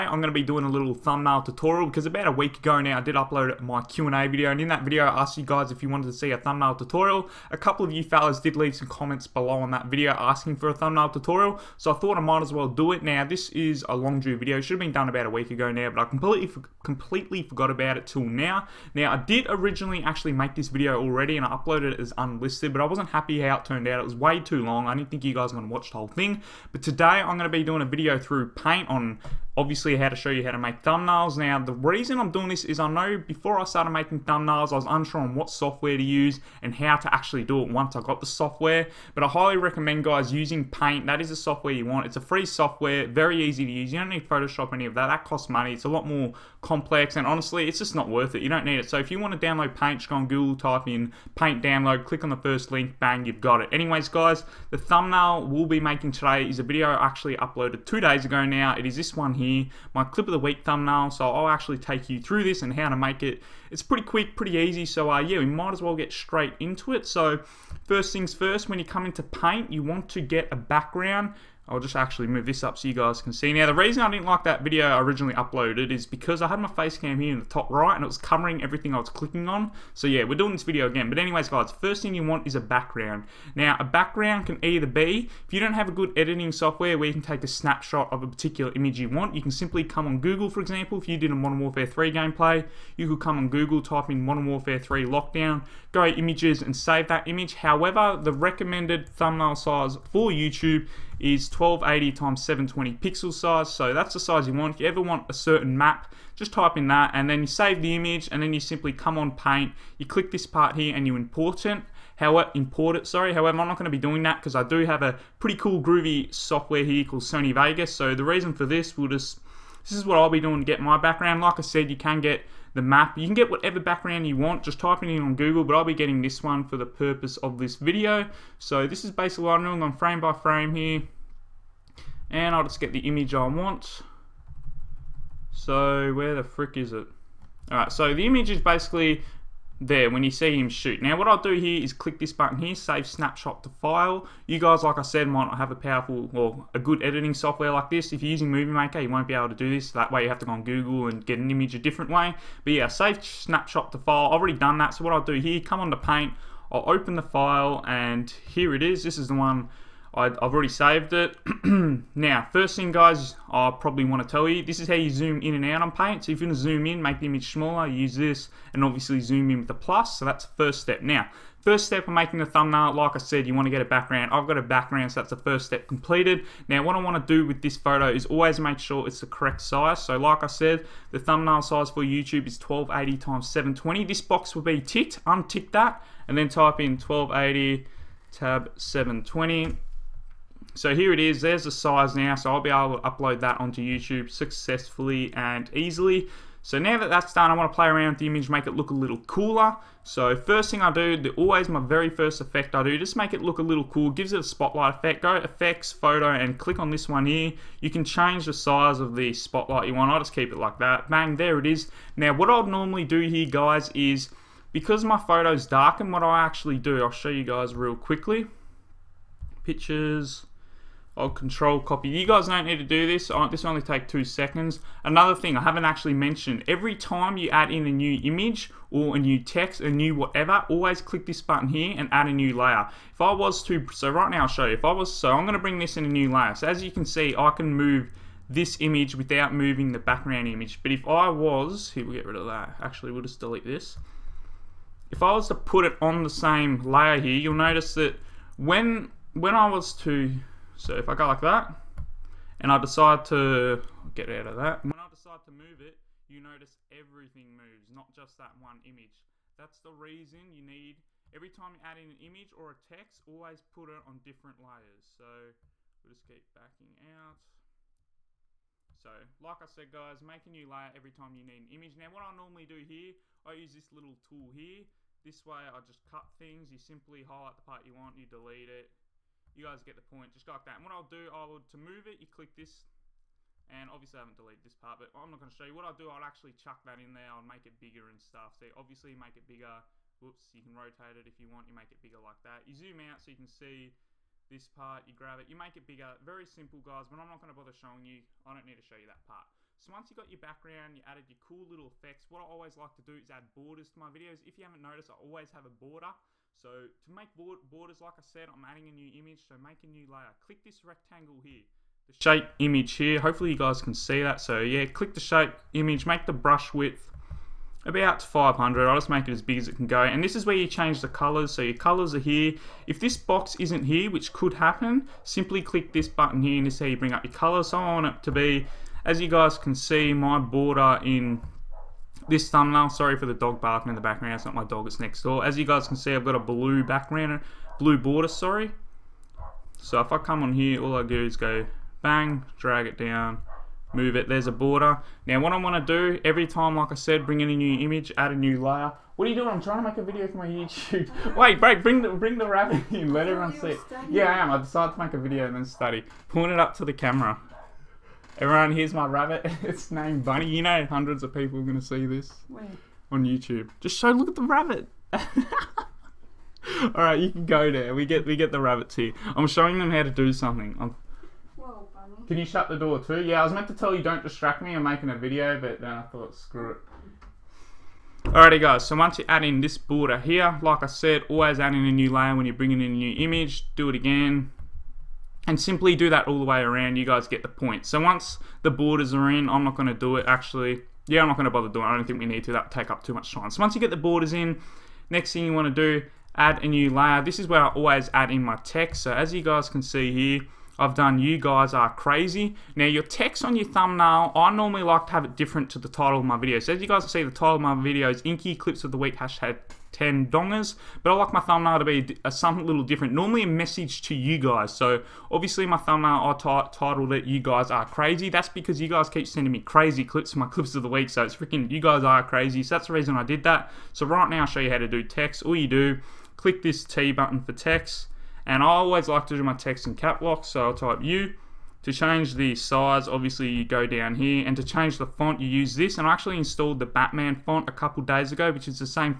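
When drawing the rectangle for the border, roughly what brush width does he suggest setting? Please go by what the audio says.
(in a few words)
500.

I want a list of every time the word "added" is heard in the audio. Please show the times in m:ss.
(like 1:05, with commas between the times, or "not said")
5:01.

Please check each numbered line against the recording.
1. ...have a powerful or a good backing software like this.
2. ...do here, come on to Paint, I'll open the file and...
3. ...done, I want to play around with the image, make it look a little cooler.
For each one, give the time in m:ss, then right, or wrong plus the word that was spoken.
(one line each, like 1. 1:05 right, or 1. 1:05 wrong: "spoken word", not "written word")
1. 2:25 wrong: "editing", not "backing"
2. 2:35 right
3. 3:17 right.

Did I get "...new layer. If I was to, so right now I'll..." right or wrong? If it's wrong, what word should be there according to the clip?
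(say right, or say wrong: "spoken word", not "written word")
right.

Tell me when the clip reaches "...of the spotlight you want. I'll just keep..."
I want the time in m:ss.
3:28.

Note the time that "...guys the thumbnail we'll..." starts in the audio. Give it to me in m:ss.
0:54.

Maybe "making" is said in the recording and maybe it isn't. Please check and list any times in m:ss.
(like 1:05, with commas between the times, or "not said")
0:33, 0:55, 2:52, 6:14.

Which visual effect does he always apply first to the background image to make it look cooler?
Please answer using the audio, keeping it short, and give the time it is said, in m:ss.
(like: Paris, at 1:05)
Spotlight effect, at 3:24.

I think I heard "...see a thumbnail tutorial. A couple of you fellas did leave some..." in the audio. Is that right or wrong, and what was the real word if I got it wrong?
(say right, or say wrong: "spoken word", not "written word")
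right.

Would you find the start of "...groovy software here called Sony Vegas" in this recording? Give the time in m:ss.
1:55.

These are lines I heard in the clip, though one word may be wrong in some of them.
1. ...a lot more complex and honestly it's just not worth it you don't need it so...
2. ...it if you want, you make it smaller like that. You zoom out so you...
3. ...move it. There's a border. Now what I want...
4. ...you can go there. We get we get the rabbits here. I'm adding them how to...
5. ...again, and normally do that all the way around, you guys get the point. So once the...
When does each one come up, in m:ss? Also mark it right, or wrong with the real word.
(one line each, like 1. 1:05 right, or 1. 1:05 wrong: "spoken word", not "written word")
1. 0:45 right
2. 4:51 wrong: "bigger", not "smaller"
3. 5:43 right
4. 6:07 wrong: "showing", not "adding"
5. 6:23 wrong: "simply", not "normally".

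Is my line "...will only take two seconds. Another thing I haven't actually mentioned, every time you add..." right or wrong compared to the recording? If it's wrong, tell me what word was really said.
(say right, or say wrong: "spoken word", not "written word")
right.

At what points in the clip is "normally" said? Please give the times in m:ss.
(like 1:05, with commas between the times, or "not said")
3:32, 4:32, 6:44, 6:53.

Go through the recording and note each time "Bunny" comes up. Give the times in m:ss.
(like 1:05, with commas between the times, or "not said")
6:00.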